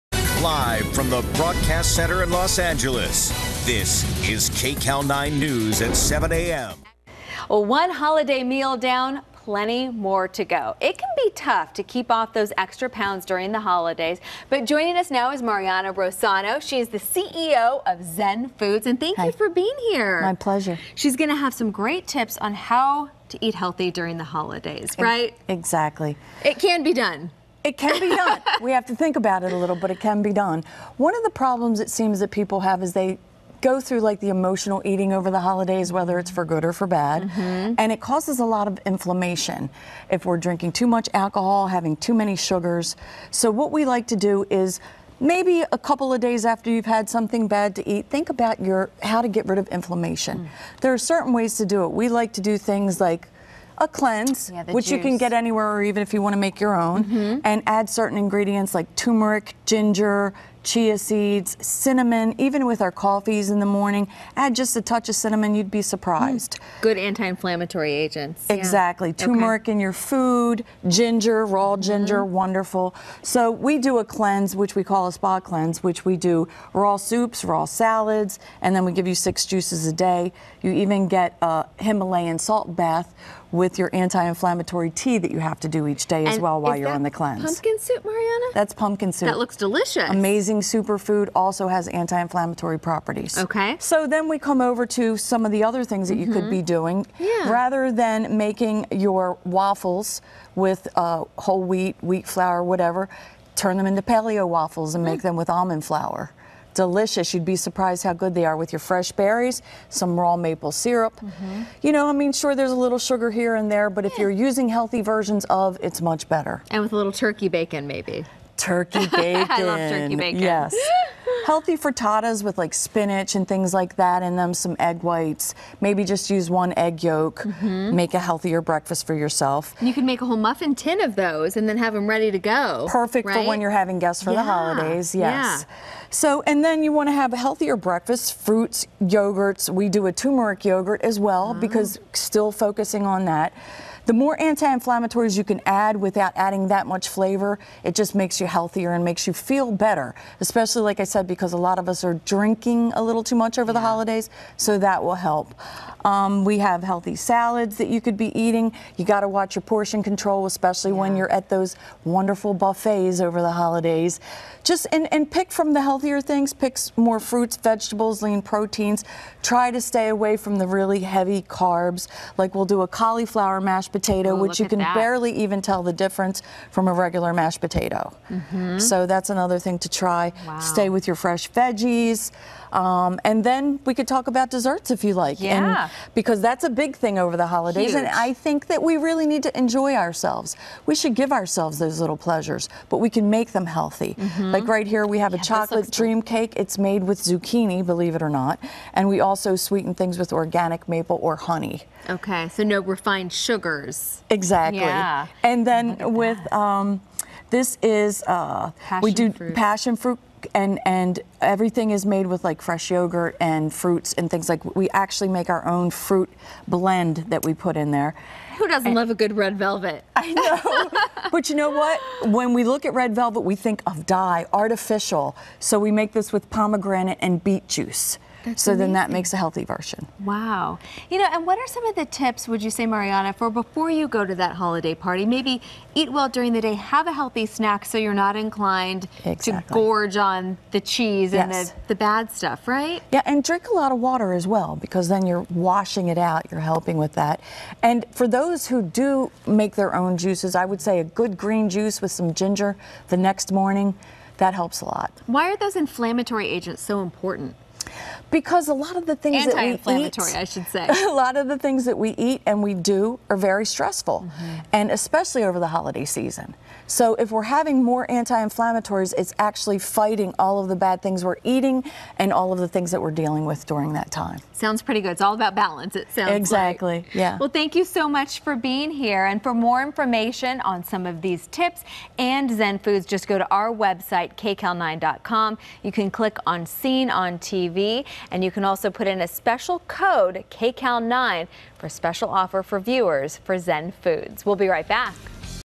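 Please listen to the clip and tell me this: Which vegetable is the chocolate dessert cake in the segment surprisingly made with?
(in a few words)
zucchini.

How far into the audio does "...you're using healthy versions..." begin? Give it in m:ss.
1:54.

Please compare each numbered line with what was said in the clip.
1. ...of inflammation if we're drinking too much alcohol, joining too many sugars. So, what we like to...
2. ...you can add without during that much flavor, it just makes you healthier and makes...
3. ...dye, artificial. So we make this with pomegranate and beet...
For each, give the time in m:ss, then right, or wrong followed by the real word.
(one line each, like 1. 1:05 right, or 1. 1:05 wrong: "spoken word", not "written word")
1. 0:38 wrong: "having", not "joining"
2. 2:25 wrong: "adding", not "during"
3. 3:44 right.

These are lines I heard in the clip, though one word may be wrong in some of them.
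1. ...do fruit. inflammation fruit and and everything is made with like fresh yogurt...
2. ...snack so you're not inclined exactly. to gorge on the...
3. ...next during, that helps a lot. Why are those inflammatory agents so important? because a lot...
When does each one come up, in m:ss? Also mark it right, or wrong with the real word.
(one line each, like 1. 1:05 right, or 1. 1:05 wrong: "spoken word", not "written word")
1. 3:29 wrong: "passion", not "inflammation"
2. 3:57 right
3. 4:13 wrong: "morning", not "during".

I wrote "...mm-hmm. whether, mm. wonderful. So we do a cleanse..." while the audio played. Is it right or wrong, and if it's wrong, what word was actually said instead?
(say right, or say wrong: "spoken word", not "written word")
wrong: "ginger", not "whether".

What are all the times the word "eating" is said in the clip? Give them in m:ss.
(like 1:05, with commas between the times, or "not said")
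0:34, 2:38, 4:31.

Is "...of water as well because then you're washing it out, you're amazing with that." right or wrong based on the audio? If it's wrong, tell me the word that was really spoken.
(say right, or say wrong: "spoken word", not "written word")
wrong: "helping", not "amazing".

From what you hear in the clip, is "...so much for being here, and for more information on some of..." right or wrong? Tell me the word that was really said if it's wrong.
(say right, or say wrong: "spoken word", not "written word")
right.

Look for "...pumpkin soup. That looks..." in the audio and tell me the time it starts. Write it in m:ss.
1:28.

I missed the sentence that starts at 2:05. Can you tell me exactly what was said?
Maybe just use one egg yolk.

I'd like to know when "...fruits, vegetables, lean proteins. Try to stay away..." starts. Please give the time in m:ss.
2:47.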